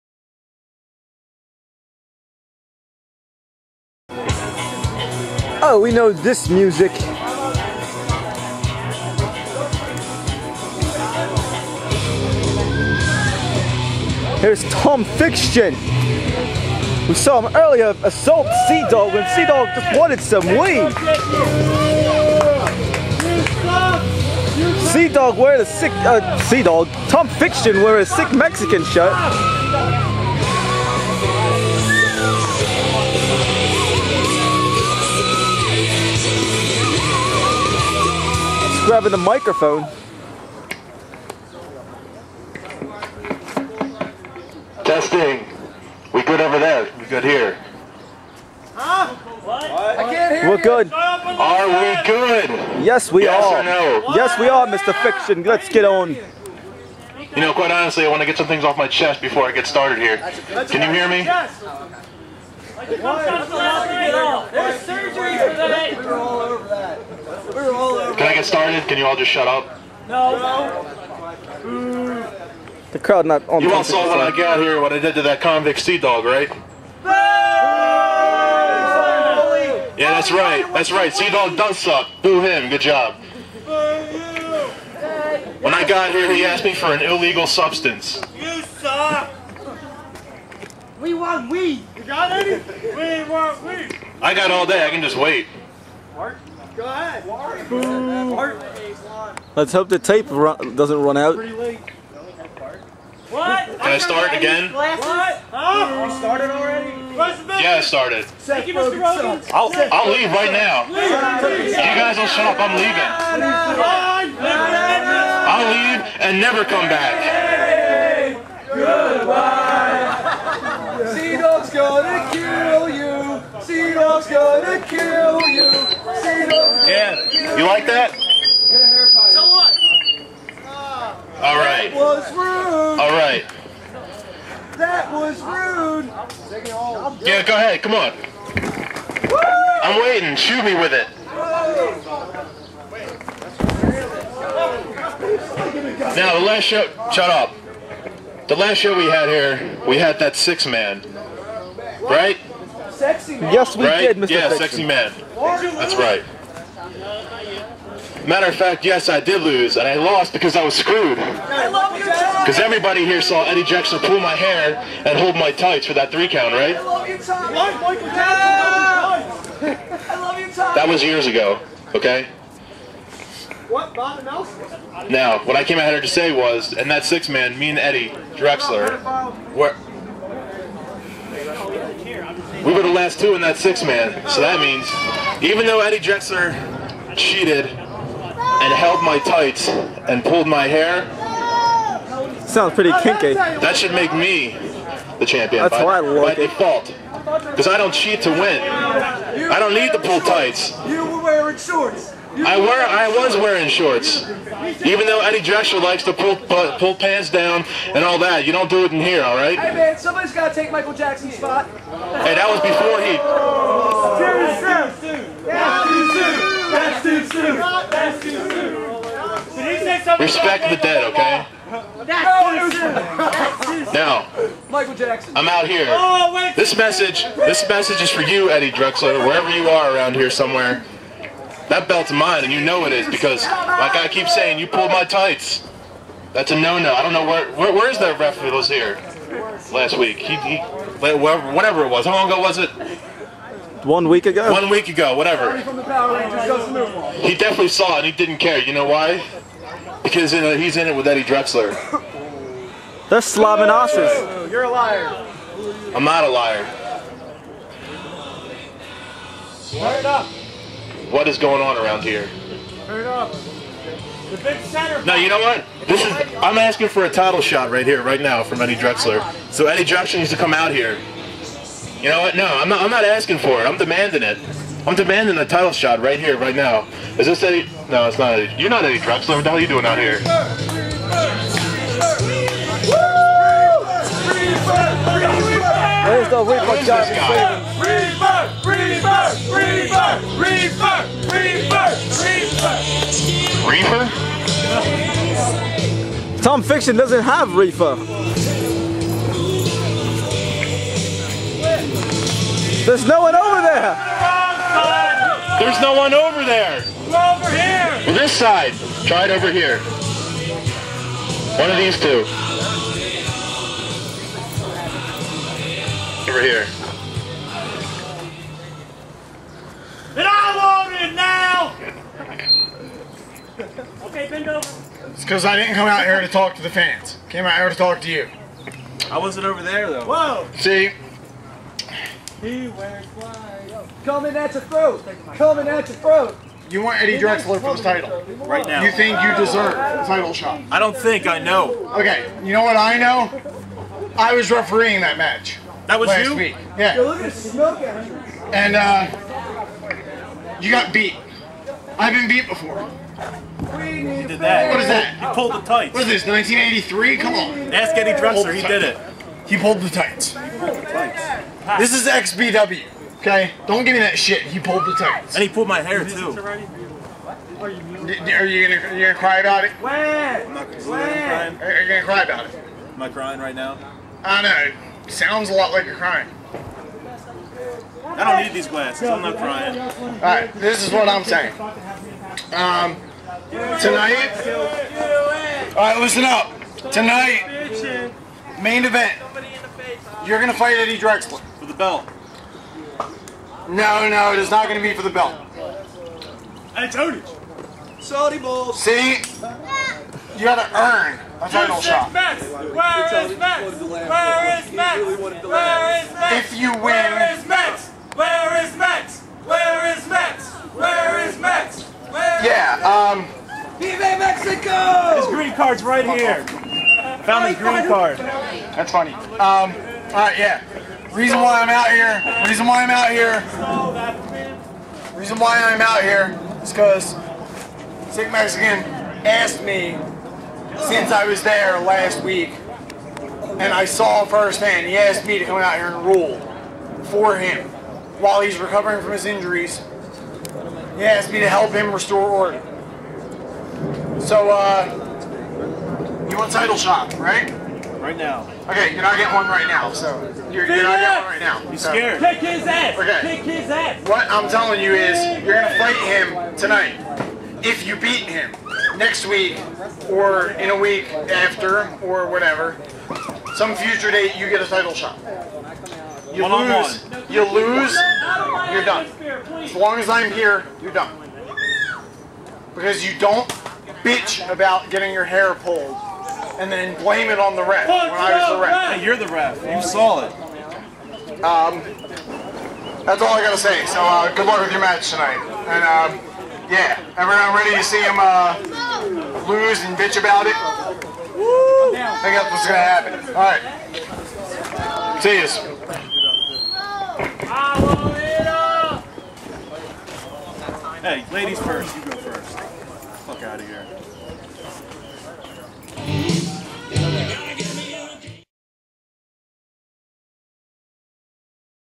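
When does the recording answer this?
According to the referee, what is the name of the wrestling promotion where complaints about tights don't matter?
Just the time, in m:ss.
6:02.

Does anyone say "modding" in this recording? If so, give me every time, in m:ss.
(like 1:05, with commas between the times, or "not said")
not said.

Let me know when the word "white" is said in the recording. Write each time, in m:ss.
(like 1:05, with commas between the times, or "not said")
5:33.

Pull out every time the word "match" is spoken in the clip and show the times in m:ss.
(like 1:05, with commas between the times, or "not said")
5:45, 8:04.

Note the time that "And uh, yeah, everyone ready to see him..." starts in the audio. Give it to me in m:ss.
8:05.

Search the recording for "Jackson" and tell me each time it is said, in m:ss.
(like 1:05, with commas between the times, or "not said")
2:43, 3:30, 3:44.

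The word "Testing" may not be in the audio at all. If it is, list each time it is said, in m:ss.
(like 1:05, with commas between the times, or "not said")
0:44.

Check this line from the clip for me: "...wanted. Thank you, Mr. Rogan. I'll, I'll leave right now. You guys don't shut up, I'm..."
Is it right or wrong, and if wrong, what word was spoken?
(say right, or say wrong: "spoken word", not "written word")
wrong: "started", not "wanted".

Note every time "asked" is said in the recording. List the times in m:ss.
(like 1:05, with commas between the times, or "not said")
1:26, 7:09, 7:14, 7:21.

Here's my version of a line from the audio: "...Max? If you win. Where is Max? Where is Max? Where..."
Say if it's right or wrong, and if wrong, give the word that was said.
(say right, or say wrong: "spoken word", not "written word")
right.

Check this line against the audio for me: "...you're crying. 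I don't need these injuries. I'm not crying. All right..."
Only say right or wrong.
wrong.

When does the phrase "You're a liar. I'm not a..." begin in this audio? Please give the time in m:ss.
4:14.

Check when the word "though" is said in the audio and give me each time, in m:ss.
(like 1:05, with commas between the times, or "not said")
3:05, 3:25, 5:29.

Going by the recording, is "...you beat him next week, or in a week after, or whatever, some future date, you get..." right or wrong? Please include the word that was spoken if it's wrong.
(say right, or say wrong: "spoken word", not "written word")
right.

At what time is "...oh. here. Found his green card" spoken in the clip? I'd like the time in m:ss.
6:56.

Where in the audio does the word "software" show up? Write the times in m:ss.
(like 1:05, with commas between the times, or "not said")
not said.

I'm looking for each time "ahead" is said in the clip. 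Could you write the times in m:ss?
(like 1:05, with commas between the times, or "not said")
1:36, 2:17.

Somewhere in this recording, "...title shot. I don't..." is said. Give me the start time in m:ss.
5:40.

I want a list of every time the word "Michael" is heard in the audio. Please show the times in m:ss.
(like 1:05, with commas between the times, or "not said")
3:30, 3:44.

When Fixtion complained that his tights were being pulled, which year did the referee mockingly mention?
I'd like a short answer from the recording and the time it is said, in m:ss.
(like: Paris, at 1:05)
1983, at 5:56.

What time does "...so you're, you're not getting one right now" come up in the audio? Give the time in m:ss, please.
7:29.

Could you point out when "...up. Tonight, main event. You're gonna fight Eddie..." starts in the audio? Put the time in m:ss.
6:26.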